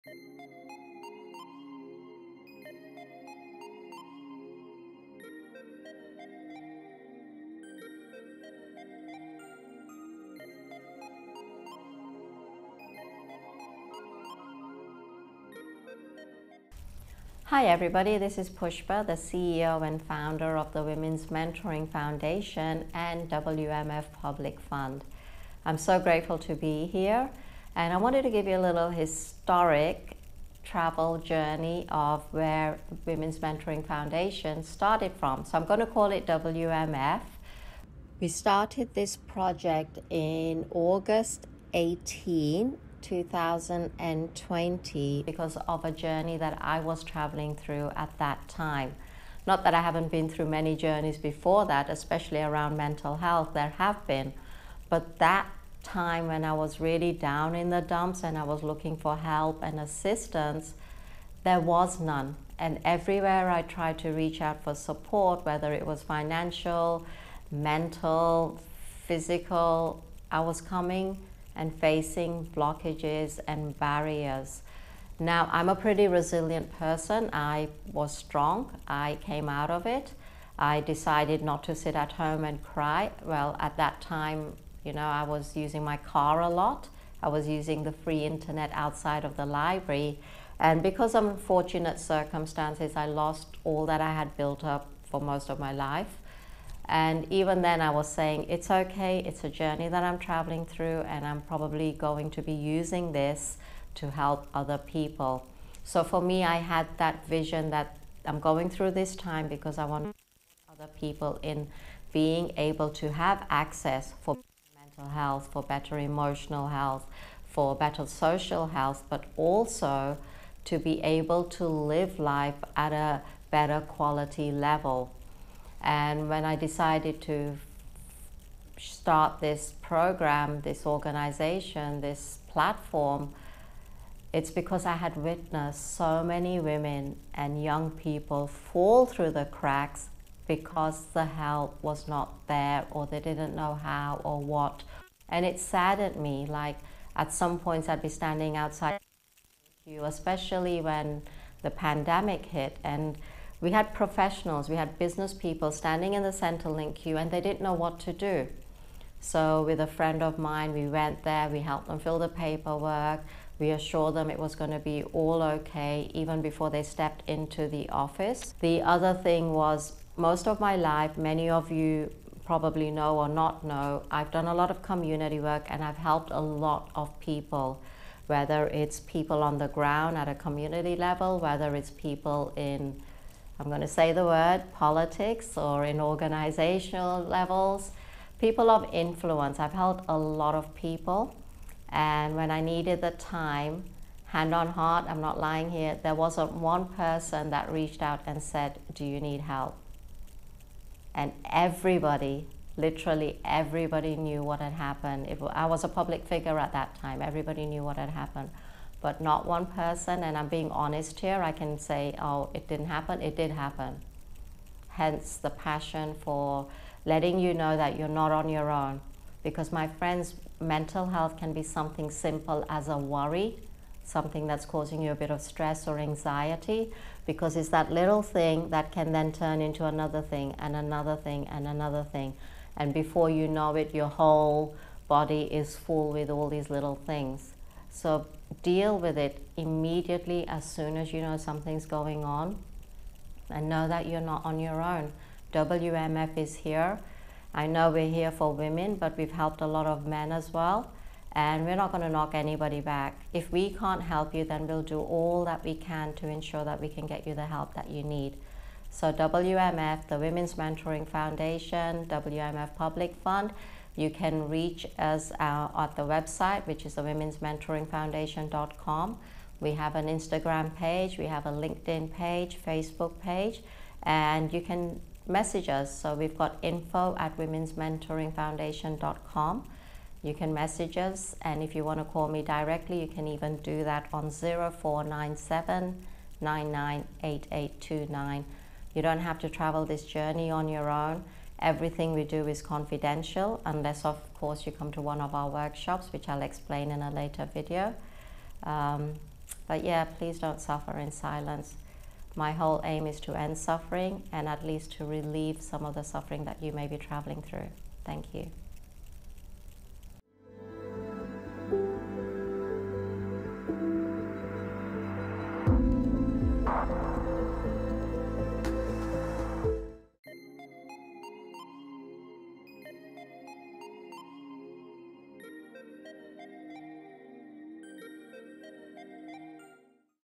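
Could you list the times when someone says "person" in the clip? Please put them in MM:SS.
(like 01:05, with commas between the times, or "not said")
01:16, 03:16, 03:29.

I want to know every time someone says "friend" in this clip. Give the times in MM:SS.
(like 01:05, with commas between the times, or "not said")
02:39, 03:39.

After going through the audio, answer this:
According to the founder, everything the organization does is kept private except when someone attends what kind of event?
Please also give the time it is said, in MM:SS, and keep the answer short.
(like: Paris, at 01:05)
workshops, at 04:55.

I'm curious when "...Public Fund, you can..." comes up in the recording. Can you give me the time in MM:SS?
04:22.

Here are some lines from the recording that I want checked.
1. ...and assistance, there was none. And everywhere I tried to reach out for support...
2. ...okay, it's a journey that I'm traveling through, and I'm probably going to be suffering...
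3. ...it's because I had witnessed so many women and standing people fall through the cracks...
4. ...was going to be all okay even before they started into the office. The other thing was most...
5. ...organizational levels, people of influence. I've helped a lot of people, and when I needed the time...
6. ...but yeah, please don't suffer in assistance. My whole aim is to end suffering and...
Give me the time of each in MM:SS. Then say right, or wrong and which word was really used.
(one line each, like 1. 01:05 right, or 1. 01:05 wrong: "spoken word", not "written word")
1. 00:59 right
2. 01:38 wrong: "using", not "suffering"
3. 02:14 wrong: "young", not "standing"
4. 02:44 wrong: "stepped", not "started"
5. 03:06 right
6. 04:59 wrong: "silence", not "assistance".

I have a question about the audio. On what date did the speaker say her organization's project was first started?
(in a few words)
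August 18, 2020.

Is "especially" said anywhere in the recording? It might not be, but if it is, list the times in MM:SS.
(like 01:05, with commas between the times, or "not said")
00:51, 02:30.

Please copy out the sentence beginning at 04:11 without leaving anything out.
And we're not going to knock anybody back.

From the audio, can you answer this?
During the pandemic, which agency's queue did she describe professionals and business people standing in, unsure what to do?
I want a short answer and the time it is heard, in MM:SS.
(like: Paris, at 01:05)
Centrelink, at 02:36.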